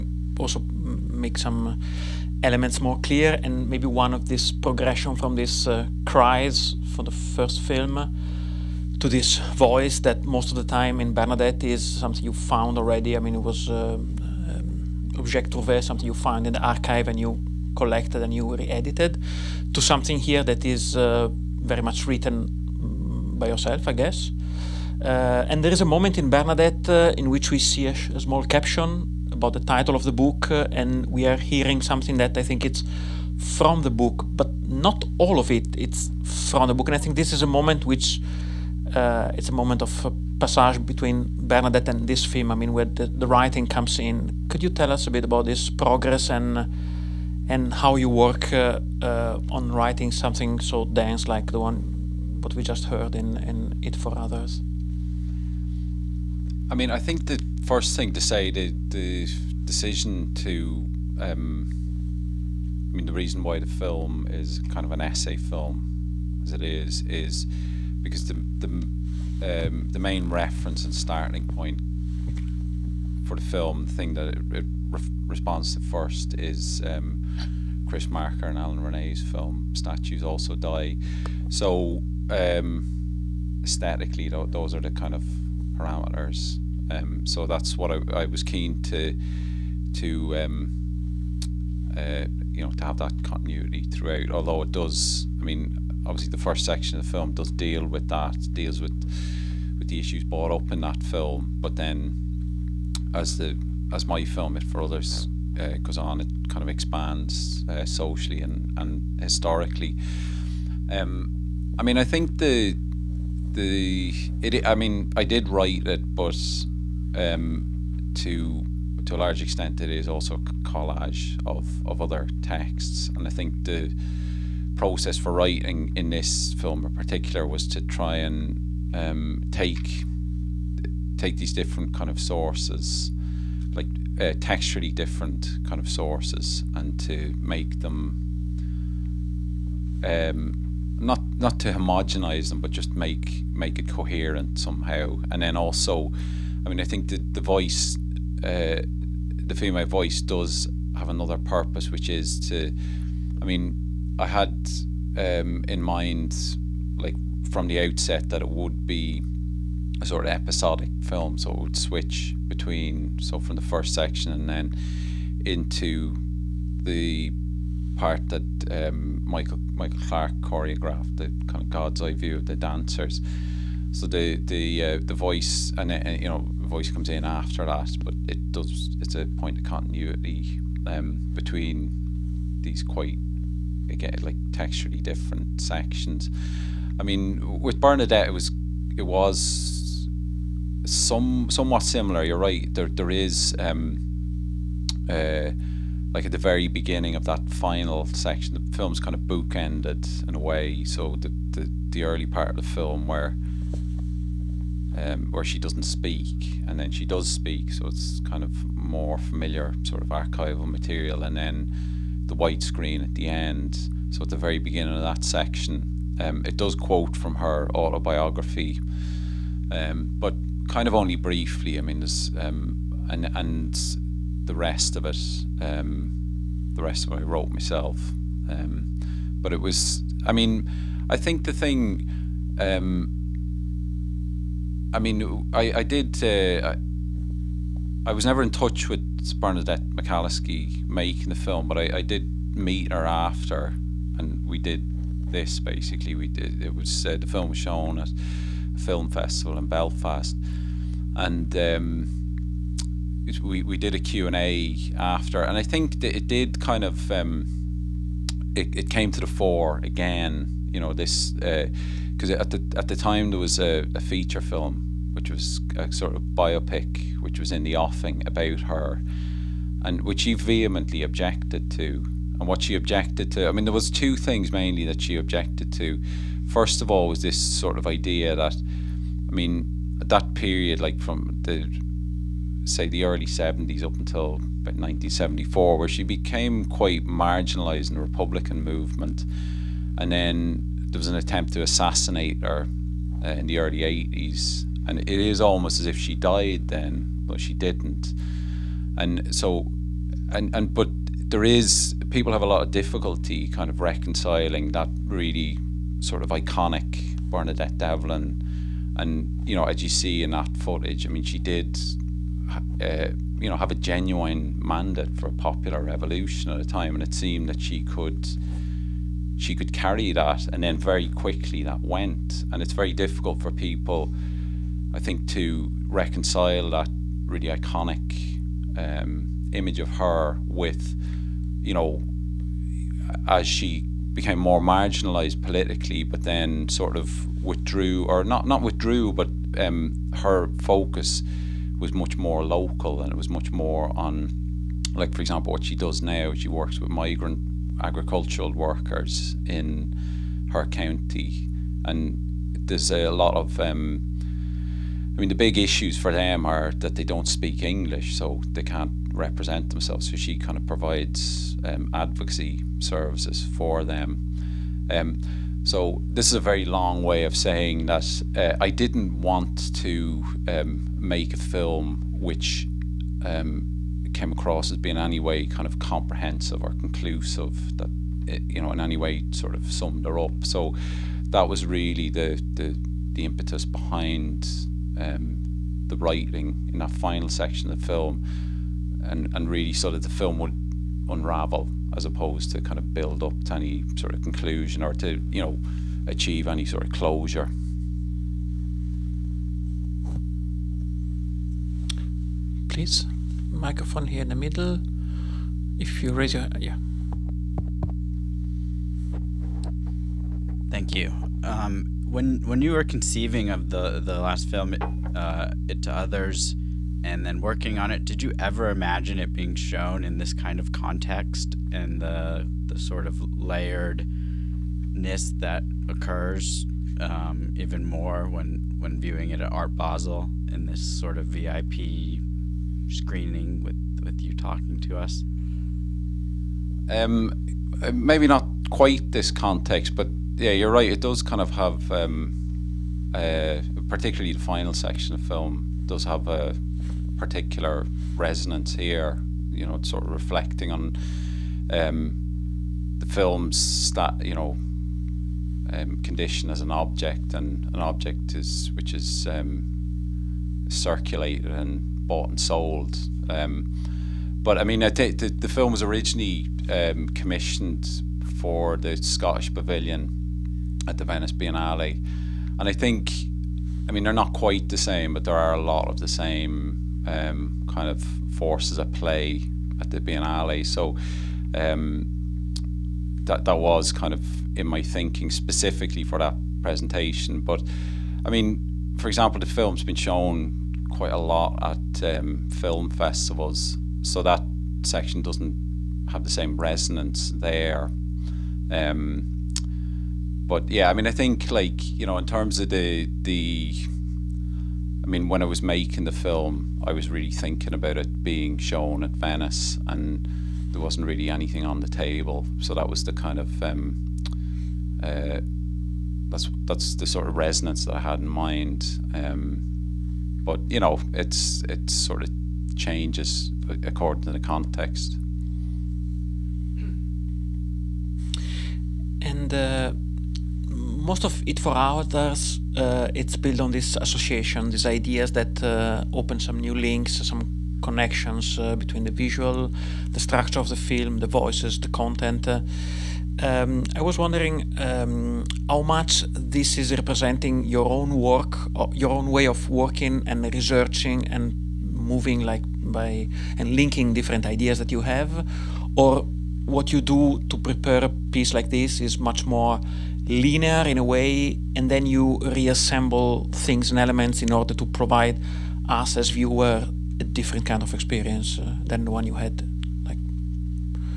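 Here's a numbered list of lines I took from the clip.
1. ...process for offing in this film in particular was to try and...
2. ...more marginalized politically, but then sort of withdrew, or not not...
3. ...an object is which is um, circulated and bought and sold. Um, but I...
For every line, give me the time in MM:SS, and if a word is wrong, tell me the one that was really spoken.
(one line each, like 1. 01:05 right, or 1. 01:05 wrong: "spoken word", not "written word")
1. 02:04 wrong: "writing", not "offing"
2. 05:34 right
3. 07:37 right.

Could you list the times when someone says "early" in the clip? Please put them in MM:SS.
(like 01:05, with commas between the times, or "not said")
03:22, 04:43, 04:53.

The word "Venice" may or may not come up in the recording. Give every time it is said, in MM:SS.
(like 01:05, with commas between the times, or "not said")
07:51, 08:29.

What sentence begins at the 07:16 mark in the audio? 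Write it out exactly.
Um, maybe not quite this context, but yeah, you're right.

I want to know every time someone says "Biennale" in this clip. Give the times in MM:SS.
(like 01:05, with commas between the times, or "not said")
07:51, 07:59.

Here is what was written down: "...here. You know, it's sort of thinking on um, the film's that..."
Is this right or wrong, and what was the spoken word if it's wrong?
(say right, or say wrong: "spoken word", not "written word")
wrong: "reflecting", not "thinking".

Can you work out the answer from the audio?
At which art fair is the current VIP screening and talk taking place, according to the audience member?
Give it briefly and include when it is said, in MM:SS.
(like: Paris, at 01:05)
Art Basel, at 07:09.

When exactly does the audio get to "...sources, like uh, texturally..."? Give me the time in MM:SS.
02:12.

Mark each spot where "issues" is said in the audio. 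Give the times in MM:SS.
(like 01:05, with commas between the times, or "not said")
01:39, 05:55.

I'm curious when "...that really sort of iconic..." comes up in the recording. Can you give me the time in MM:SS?
05:04.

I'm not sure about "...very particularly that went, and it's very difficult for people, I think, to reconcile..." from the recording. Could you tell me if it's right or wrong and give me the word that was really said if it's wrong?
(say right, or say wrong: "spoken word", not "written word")
wrong: "quickly", not "particularly".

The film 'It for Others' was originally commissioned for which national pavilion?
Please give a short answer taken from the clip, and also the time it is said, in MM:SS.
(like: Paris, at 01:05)
Scottish Pavilion, at 07:48.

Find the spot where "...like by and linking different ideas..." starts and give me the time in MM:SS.
09:12.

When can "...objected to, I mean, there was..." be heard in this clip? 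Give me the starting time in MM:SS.
04:32.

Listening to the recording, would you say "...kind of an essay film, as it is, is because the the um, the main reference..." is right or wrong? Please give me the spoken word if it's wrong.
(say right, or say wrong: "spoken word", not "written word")
right.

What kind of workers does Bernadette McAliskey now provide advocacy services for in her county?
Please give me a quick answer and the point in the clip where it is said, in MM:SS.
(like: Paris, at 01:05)
migrant agricultural workers, at 05:46.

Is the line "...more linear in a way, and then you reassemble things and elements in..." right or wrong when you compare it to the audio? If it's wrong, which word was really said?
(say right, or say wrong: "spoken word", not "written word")
right.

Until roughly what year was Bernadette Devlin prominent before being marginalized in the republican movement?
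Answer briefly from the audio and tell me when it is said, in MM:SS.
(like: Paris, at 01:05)
1974, at 04:44.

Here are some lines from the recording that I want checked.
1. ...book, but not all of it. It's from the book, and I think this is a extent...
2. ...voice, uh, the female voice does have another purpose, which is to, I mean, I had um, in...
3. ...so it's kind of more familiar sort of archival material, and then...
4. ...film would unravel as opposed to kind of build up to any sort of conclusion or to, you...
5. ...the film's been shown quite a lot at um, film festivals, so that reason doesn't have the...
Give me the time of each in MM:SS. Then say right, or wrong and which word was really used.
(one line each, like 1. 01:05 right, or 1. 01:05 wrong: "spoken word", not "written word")
1. 00:33 wrong: "moment", not "extent"
2. 02:27 right
3. 03:27 right
4. 06:30 right
5. 08:09 wrong: "section", not "reason".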